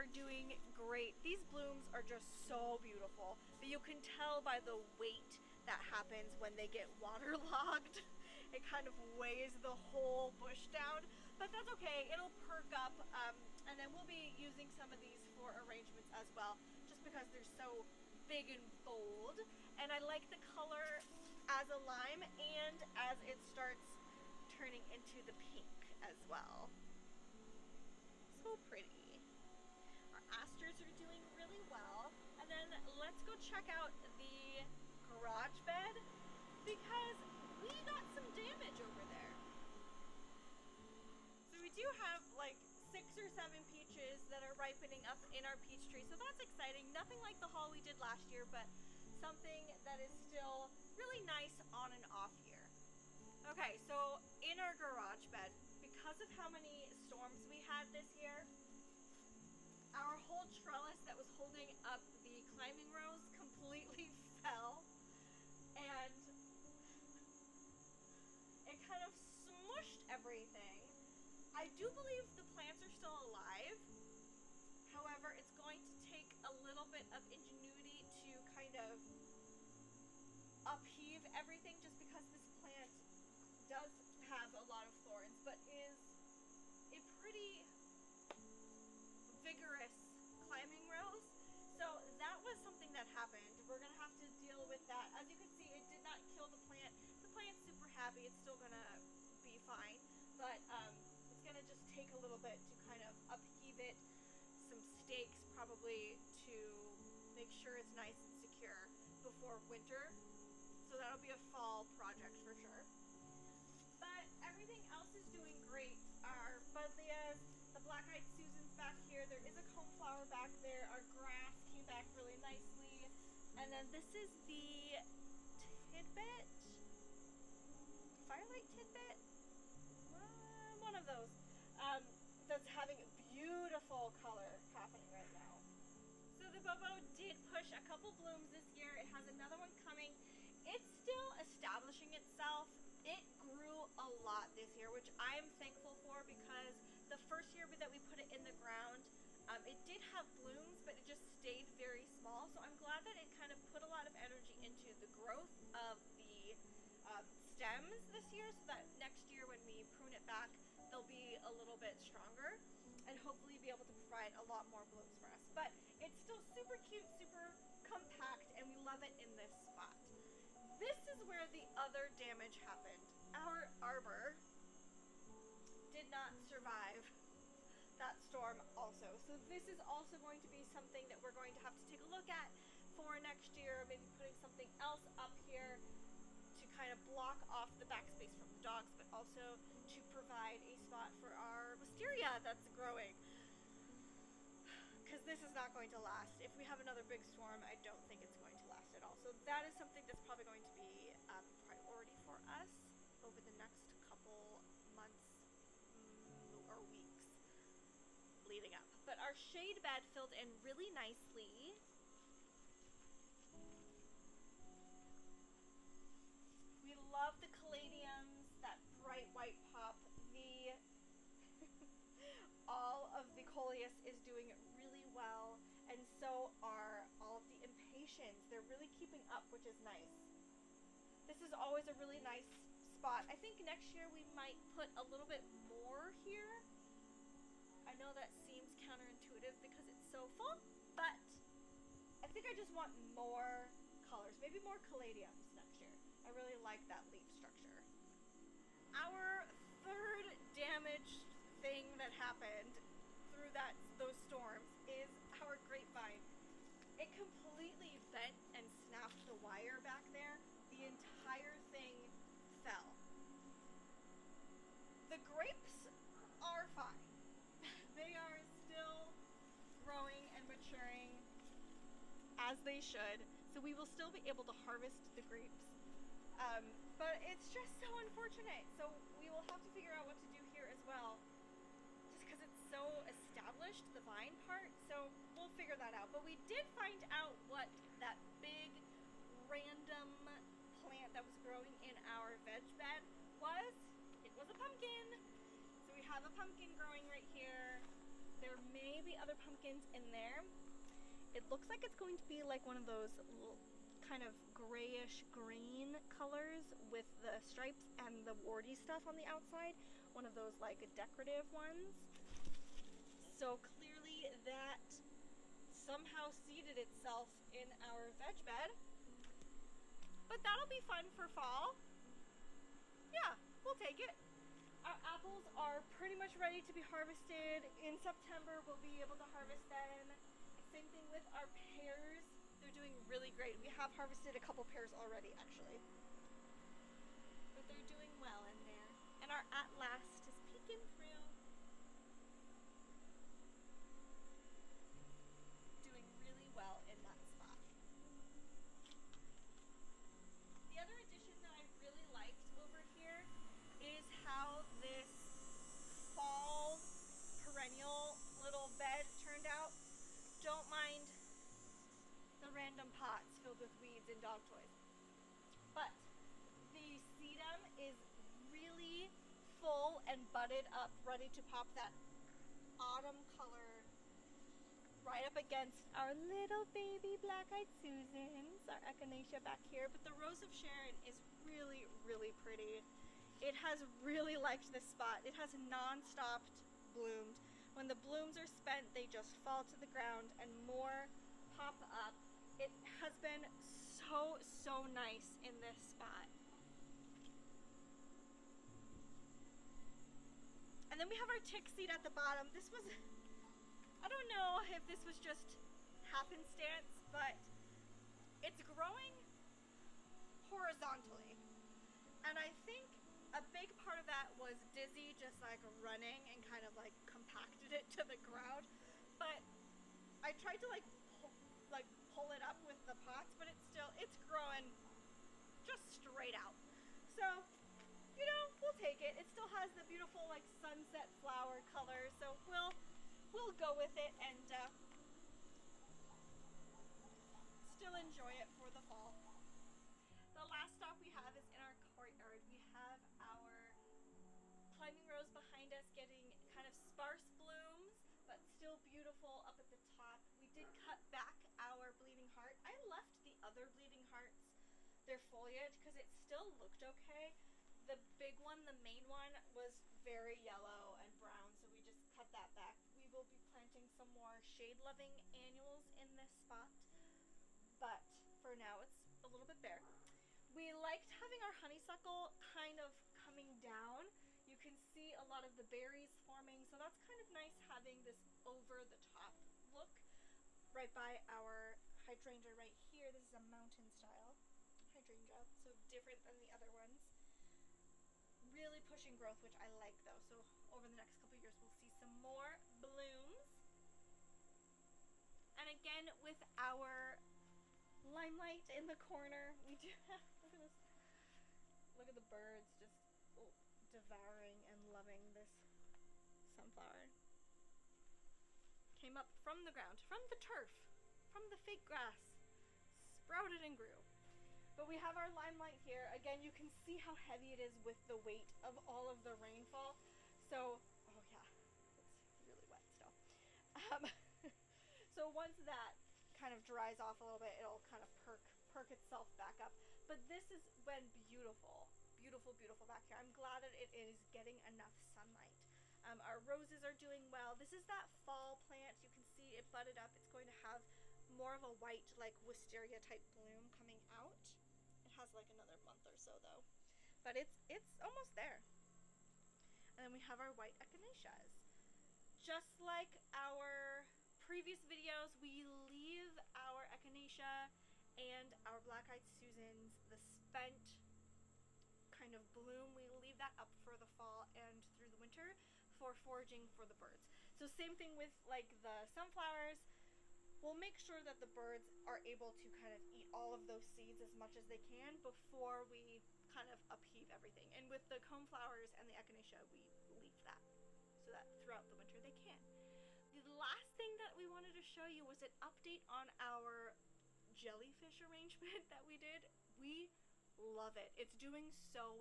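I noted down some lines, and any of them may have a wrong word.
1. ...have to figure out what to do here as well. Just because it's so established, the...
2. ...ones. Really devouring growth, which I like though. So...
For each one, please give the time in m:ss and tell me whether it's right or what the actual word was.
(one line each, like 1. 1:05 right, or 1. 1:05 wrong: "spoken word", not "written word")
1. 4:39 right
2. 8:06 wrong: "pushing", not "devouring".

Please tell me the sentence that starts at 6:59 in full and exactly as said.
But I tried to like pull it up with the pots, but it's still, it's growing just straight out.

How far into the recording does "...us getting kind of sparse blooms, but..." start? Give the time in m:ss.
7:25.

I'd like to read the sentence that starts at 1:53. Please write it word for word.
But everything else is doing great.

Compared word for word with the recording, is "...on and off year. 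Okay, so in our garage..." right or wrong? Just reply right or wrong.
right.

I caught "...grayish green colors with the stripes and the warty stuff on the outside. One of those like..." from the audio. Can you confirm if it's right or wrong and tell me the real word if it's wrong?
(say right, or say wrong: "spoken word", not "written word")
right.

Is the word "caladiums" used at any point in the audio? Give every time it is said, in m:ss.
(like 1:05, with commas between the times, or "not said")
3:37, 4:04.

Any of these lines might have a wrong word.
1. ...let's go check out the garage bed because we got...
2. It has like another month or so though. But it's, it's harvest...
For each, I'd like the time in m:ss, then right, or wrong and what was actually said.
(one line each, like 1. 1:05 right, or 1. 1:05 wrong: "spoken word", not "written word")
1. 0:32 right
2. 9:05 wrong: "almost", not "harvest".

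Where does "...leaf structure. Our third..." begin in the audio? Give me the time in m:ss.
4:07.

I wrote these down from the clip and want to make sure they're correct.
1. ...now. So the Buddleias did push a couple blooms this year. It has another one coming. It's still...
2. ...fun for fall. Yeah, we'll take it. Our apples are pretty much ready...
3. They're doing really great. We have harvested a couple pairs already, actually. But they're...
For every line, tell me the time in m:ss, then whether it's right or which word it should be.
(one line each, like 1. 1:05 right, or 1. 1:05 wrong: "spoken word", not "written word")
1. 2:15 wrong: "Bobo", not "Buddleias"
2. 5:20 right
3. 5:32 right.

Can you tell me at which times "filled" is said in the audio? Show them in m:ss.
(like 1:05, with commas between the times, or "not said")
3:30, 6:03.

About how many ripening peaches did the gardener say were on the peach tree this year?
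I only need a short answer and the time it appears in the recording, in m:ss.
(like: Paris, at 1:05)
6 or 7, at 0:42.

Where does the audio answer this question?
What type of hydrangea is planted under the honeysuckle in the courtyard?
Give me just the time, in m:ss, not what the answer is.
8:03.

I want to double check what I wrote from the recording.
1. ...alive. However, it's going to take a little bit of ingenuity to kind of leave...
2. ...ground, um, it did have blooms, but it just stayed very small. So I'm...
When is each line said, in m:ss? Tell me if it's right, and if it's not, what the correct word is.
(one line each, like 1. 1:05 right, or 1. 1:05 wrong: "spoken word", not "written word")
1. 1:13 wrong: "upheave", not "leave"
2. 2:28 right.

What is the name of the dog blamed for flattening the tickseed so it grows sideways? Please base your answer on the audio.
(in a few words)
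Dizzy.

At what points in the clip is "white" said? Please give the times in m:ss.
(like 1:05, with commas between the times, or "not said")
3:39, 9:01, 9:10.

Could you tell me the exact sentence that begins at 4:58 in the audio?
There may be other pumpkins in there.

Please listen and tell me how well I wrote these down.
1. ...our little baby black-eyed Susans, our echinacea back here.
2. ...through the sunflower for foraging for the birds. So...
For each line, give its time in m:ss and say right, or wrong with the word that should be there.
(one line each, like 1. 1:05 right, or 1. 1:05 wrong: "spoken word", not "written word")
1. 6:15 right
2. 9:24 wrong: "winter", not "sunflower".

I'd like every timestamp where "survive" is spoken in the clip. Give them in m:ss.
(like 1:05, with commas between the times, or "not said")
2:56.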